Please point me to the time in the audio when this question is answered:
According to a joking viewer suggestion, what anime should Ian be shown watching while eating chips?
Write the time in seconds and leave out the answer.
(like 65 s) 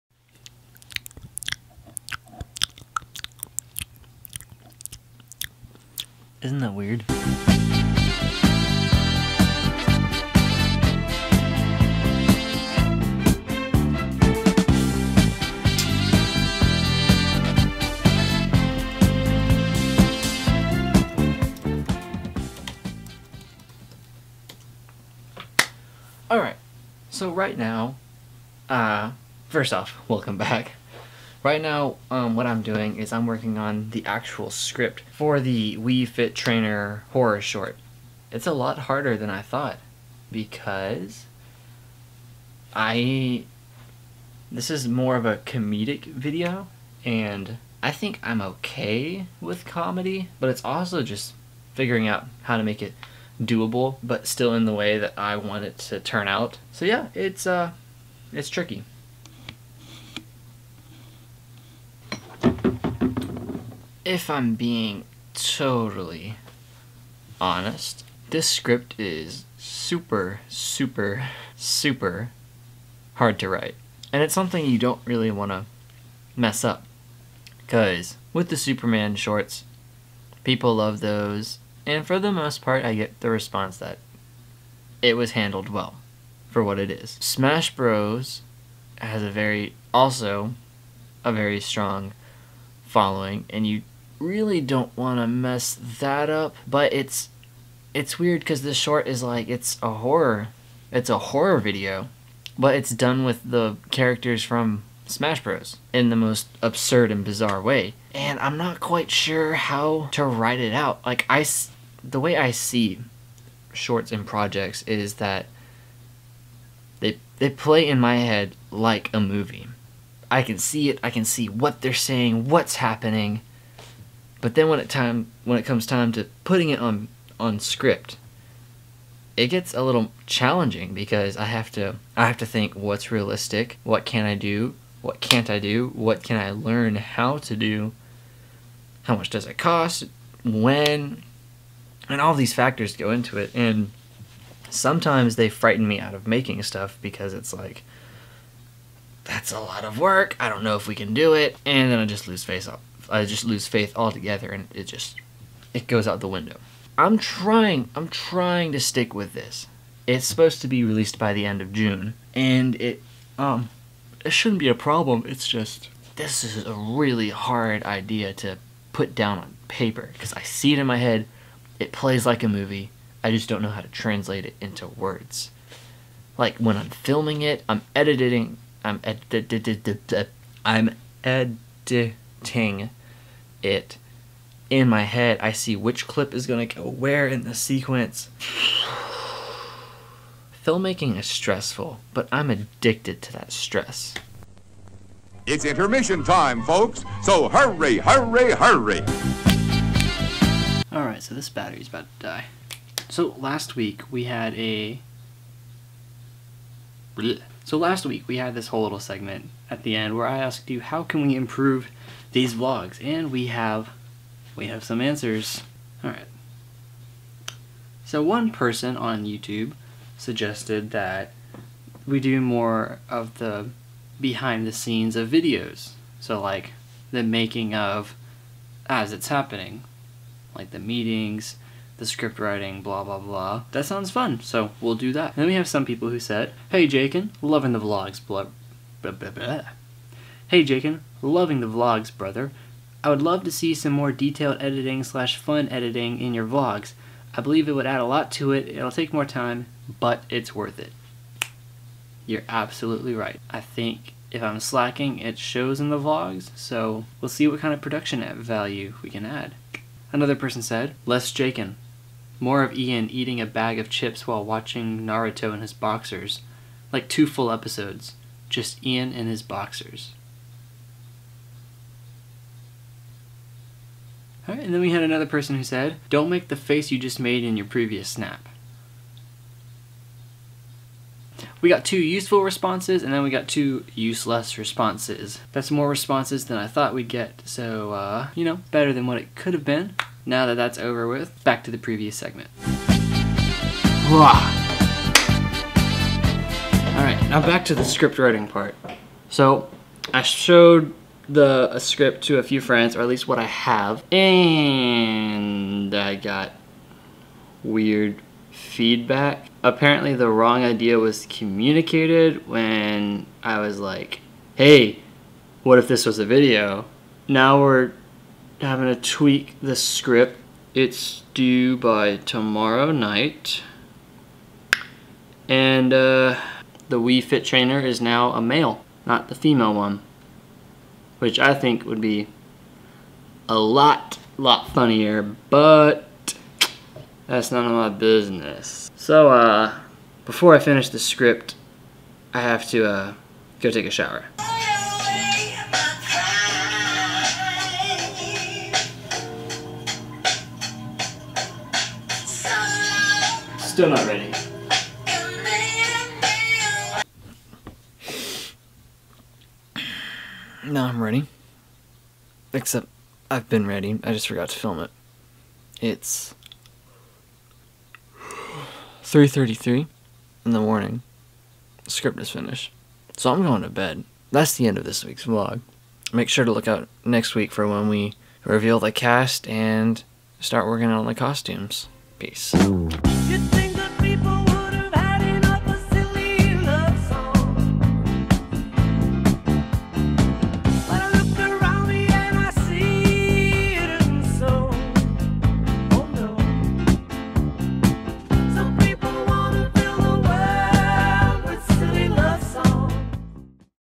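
265 s.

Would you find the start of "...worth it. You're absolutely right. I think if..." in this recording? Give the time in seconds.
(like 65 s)
250 s.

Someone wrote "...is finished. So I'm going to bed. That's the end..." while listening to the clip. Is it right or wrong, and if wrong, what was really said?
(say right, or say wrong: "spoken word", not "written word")
right.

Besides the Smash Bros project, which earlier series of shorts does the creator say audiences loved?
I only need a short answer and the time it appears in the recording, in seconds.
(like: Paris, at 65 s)
Superman shorts, at 78 s.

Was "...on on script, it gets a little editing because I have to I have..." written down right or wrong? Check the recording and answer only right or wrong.
wrong.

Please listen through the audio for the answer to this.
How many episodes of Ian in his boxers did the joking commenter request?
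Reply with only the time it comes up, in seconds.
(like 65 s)
267 s.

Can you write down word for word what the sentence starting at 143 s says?
And sometimes they frighten me out of making stuff because it's like that's a lot of work.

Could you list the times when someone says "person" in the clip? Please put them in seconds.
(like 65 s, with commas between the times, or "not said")
218 s, 260 s, 275 s.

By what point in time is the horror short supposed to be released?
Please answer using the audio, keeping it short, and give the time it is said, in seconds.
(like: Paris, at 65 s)
End of June, at 161 s.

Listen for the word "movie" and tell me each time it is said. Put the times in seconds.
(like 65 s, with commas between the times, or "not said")
119 s, 172 s.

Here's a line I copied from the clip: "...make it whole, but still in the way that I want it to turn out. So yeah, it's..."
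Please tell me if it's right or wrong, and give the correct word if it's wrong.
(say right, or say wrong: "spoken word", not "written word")
wrong: "doable", not "whole".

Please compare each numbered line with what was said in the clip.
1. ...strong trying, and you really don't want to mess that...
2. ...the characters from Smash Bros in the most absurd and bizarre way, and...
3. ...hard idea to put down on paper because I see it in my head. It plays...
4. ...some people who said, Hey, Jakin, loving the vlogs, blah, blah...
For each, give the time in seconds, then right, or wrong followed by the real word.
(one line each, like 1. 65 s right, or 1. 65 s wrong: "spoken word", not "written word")
1. 91 s wrong: "following", not "trying"
2. 103 s right
3. 167 s right
4. 235 s right.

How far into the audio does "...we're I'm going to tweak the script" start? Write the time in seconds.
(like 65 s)
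317 s.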